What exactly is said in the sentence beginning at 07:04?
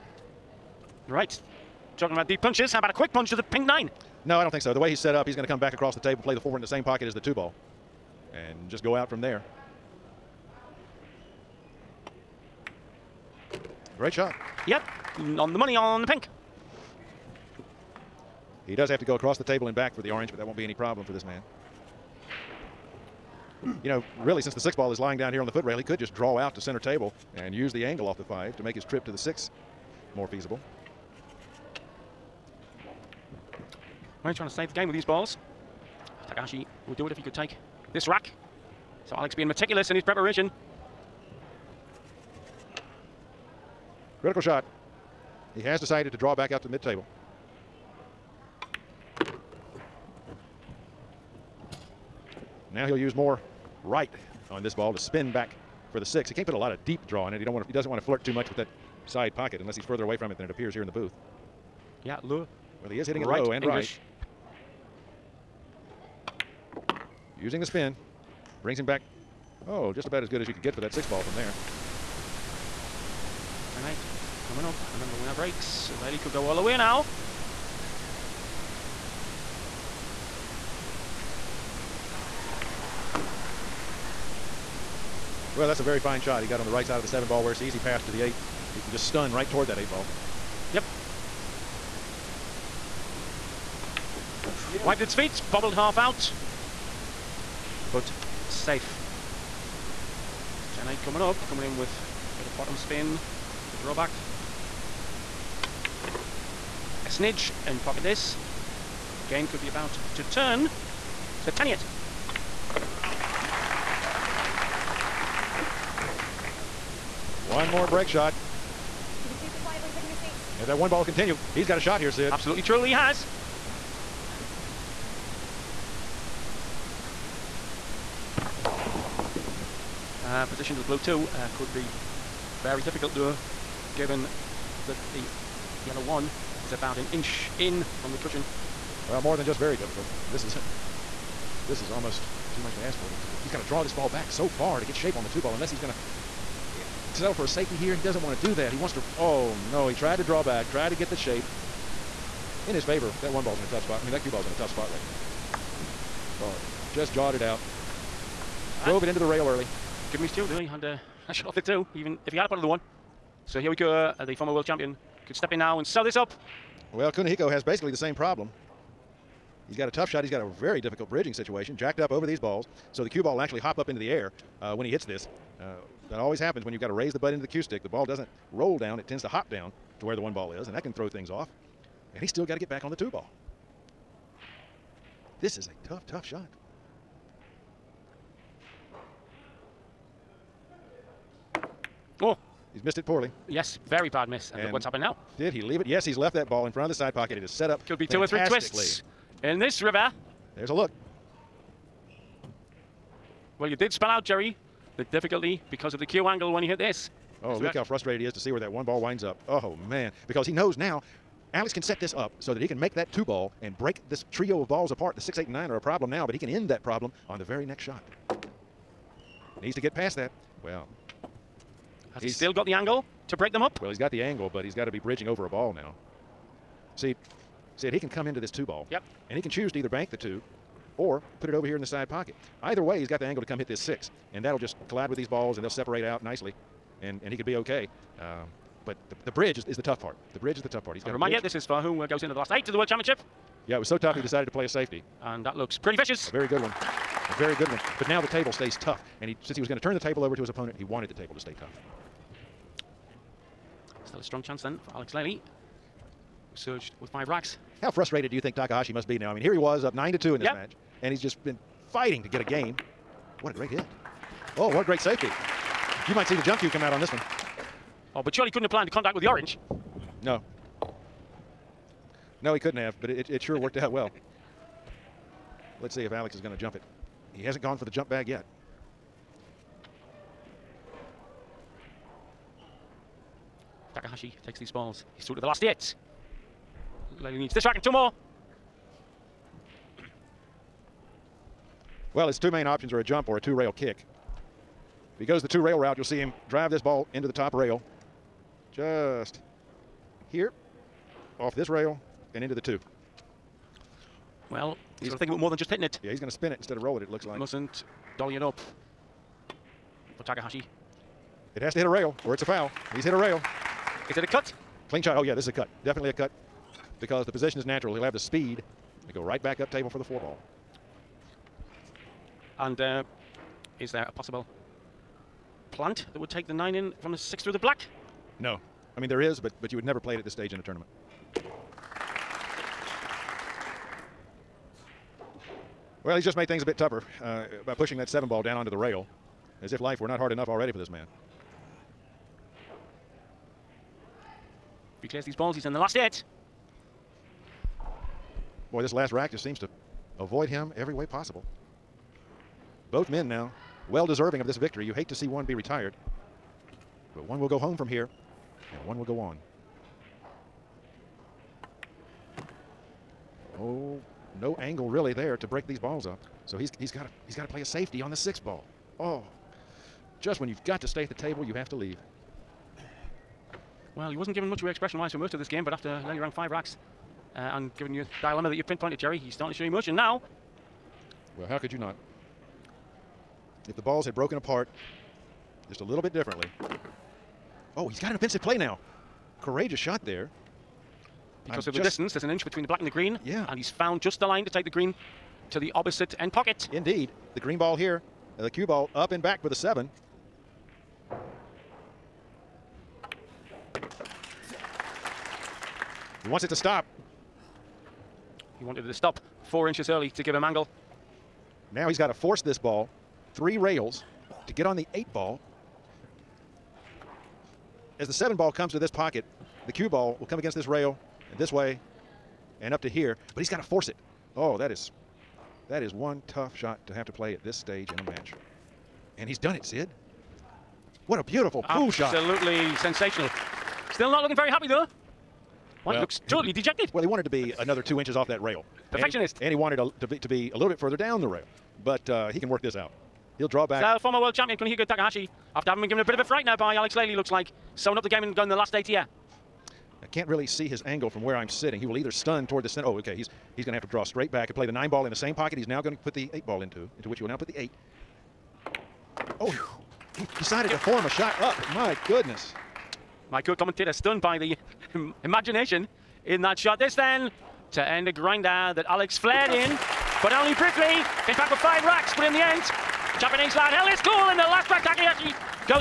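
Oh, that is that is one tough shot to have to play at this stage in a match.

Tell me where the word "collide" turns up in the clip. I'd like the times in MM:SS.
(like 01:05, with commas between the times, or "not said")
03:54.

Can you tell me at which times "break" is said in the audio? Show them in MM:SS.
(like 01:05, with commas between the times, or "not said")
01:15, 01:57, 03:33, 03:43, 06:05.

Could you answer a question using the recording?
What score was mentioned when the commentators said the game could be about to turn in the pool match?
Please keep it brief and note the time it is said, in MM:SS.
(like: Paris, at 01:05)
10-8, at 01:40.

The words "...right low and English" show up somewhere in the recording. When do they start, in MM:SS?
01:03.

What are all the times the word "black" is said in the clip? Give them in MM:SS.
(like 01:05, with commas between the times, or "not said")
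05:27, 06:32.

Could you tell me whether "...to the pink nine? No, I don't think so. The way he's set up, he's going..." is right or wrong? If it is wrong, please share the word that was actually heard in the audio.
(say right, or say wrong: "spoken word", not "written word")
right.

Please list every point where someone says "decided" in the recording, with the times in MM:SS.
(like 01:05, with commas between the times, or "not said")
00:45, 04:04, 07:40.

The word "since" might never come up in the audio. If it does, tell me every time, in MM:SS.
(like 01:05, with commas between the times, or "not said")
00:24, 04:09.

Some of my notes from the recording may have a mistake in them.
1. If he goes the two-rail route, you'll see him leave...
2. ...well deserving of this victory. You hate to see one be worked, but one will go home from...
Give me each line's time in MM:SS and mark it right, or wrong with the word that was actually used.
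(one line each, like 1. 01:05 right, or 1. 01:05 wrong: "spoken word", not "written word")
1. 04:55 wrong: "drive", not "leave"
2. 05:53 wrong: "retired", not "worked".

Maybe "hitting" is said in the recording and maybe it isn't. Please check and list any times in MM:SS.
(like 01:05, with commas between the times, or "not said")
01:03, 05:05.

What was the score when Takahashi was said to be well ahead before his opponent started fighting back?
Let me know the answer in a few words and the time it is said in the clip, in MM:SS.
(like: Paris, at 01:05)
9 to 2, at 04:19.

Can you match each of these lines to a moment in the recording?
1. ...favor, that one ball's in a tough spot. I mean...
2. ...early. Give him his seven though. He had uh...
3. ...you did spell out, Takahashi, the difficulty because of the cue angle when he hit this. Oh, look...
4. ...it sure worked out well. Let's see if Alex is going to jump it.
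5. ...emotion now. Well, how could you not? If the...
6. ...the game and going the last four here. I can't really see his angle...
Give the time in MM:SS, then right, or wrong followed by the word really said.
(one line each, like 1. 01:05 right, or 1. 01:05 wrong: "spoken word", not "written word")
1. 02:32 right
2. 02:39 wrong: "two", not "seven"
3. 03:23 wrong: "Jerry", not "Takahashi"
4. 04:33 right
5. 06:19 right
6. 07:28 wrong: "eight", not "four".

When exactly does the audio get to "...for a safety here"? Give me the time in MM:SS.
02:27.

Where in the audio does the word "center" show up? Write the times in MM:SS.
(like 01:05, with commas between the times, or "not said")
00:26, 07:32.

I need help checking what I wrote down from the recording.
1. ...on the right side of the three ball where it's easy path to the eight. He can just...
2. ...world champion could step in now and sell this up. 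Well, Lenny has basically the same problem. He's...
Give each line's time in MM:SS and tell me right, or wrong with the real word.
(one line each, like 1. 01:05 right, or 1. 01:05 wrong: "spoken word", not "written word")
1. 01:26 wrong: "seven", not "three"
2. 02:44 wrong: "Kunihiko", not "Lenny".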